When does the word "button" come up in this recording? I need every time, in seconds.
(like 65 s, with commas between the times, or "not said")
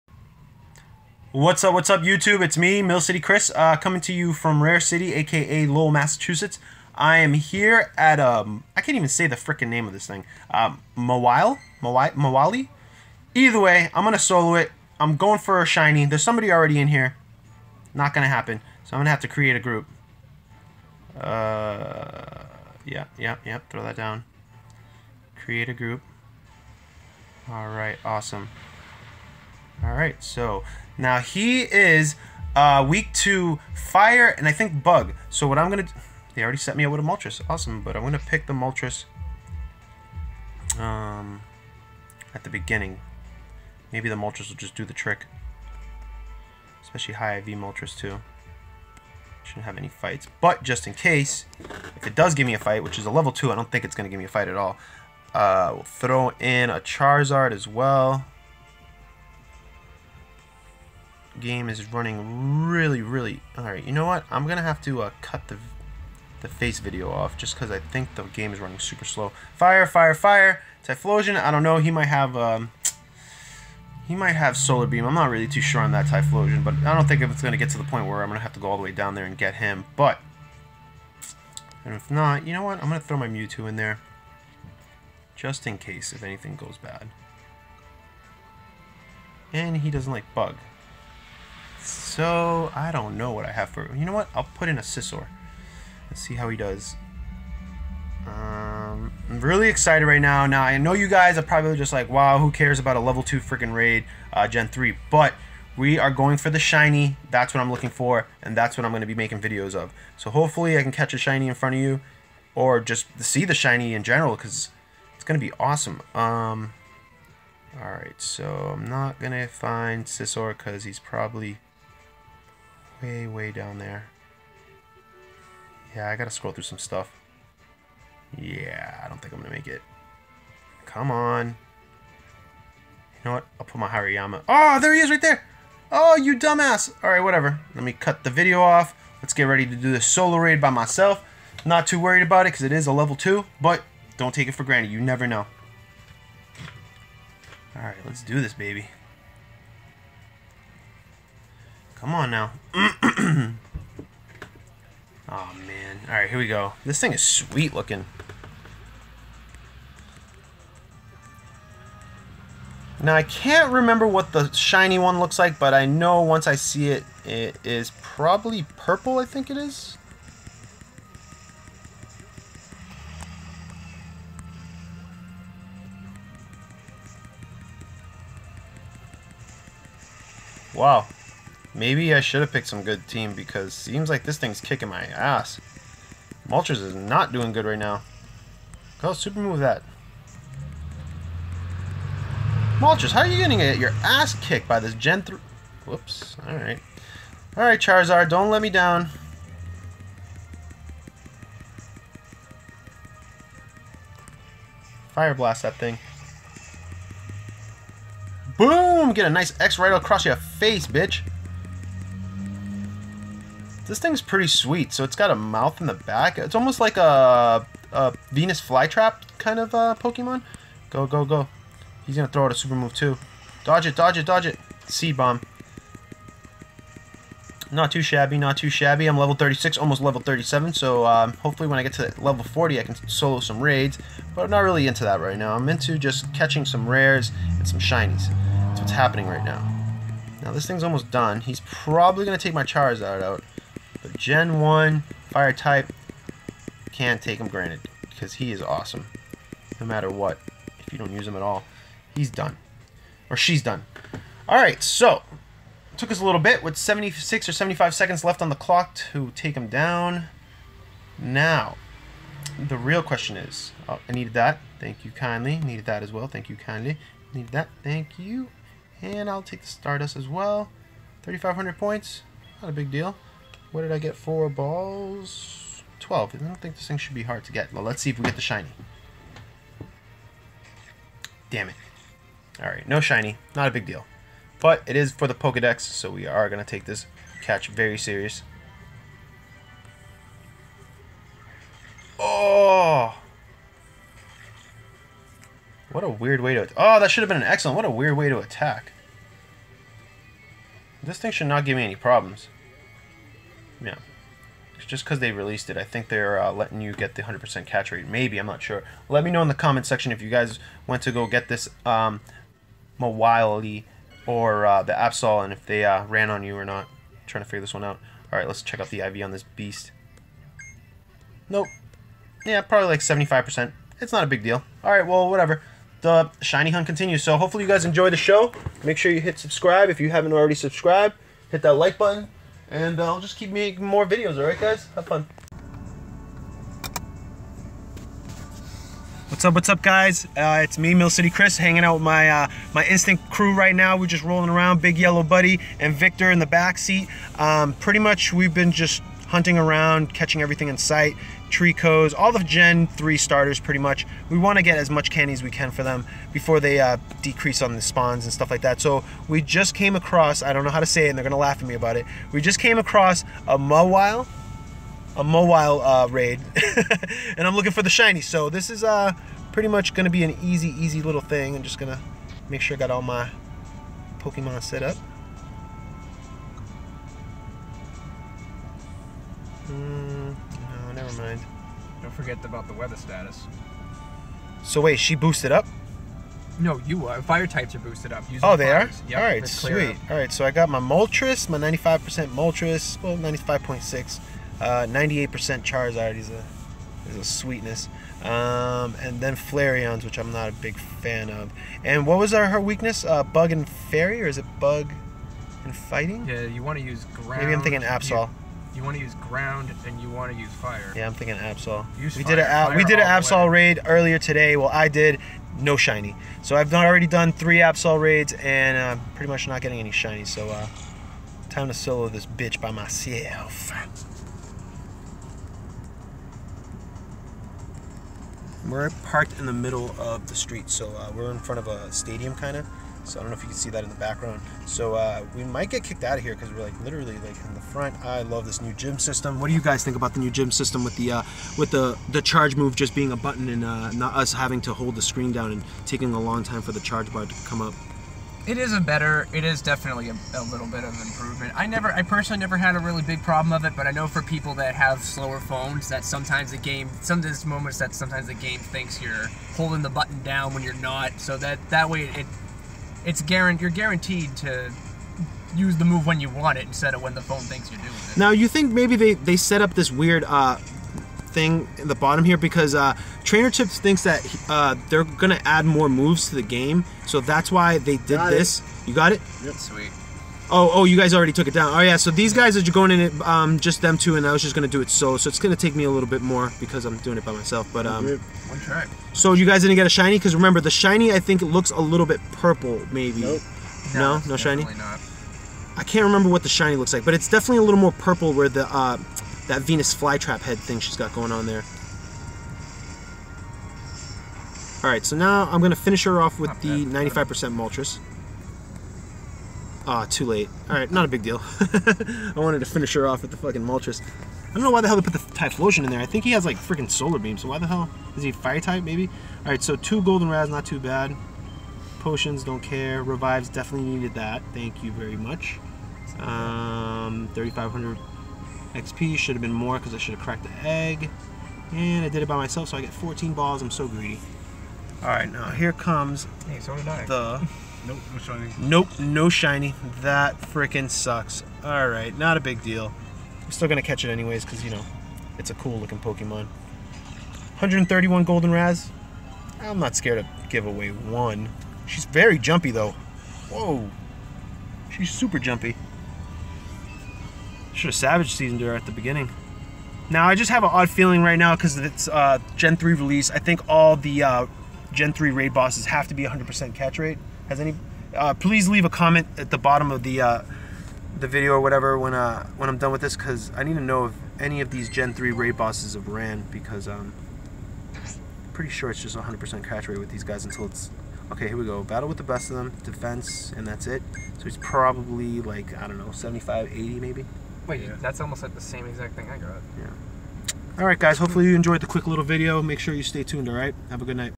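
331 s, 443 s, 459 s.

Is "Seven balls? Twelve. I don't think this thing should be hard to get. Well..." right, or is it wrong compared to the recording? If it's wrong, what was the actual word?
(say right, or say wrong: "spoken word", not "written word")
wrong: "Four", not "Seven".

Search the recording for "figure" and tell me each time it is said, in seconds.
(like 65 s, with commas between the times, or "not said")
317 s.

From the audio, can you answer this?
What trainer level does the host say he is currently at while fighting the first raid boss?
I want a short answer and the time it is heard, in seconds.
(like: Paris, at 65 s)
36, at 229 s.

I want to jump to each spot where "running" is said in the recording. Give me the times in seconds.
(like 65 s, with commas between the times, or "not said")
61 s, 68 s.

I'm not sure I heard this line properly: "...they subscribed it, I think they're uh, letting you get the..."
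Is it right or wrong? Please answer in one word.
wrong.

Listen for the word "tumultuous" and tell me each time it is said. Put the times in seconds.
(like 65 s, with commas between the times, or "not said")
not said.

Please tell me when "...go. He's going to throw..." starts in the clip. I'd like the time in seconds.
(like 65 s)
221 s.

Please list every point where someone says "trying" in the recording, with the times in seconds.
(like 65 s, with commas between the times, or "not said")
317 s.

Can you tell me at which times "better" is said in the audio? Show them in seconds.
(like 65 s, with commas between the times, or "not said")
448 s.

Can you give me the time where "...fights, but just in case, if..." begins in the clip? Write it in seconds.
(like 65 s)
49 s.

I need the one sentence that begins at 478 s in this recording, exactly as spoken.
you got it yep sweet Oh, oh, you guys already took it down.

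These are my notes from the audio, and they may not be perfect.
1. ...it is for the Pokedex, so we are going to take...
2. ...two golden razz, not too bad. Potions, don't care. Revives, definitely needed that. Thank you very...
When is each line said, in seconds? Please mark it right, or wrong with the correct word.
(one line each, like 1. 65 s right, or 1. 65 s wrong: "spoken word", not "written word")
1. 284 s right
2. 519 s right.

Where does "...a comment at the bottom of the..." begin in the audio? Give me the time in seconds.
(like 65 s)
568 s.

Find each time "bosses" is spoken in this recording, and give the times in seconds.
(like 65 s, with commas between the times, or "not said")
565 s, 575 s.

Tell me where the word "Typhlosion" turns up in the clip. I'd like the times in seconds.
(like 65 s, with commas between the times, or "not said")
70 s, 76 s, 515 s.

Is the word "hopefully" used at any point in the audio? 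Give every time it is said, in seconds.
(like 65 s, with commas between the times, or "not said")
110 s, 231 s, 327 s, 591 s.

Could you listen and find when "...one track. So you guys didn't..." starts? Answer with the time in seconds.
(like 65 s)
488 s.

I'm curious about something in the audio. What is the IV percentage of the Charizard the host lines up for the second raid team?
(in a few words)
98%.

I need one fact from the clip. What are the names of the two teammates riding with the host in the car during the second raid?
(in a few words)
Big Yellow Buddy and Victor.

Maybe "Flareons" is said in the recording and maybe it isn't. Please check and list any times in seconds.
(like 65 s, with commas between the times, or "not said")
399 s.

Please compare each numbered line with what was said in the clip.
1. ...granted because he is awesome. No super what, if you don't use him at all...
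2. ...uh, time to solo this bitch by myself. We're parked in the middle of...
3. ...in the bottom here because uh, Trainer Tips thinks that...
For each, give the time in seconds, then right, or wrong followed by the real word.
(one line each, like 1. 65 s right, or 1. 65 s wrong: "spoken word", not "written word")
1. 247 s wrong: "matter", not "super"
2. 420 s right
3. 471 s right.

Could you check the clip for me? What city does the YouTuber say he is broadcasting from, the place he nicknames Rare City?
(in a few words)
Lowell, Massachusetts.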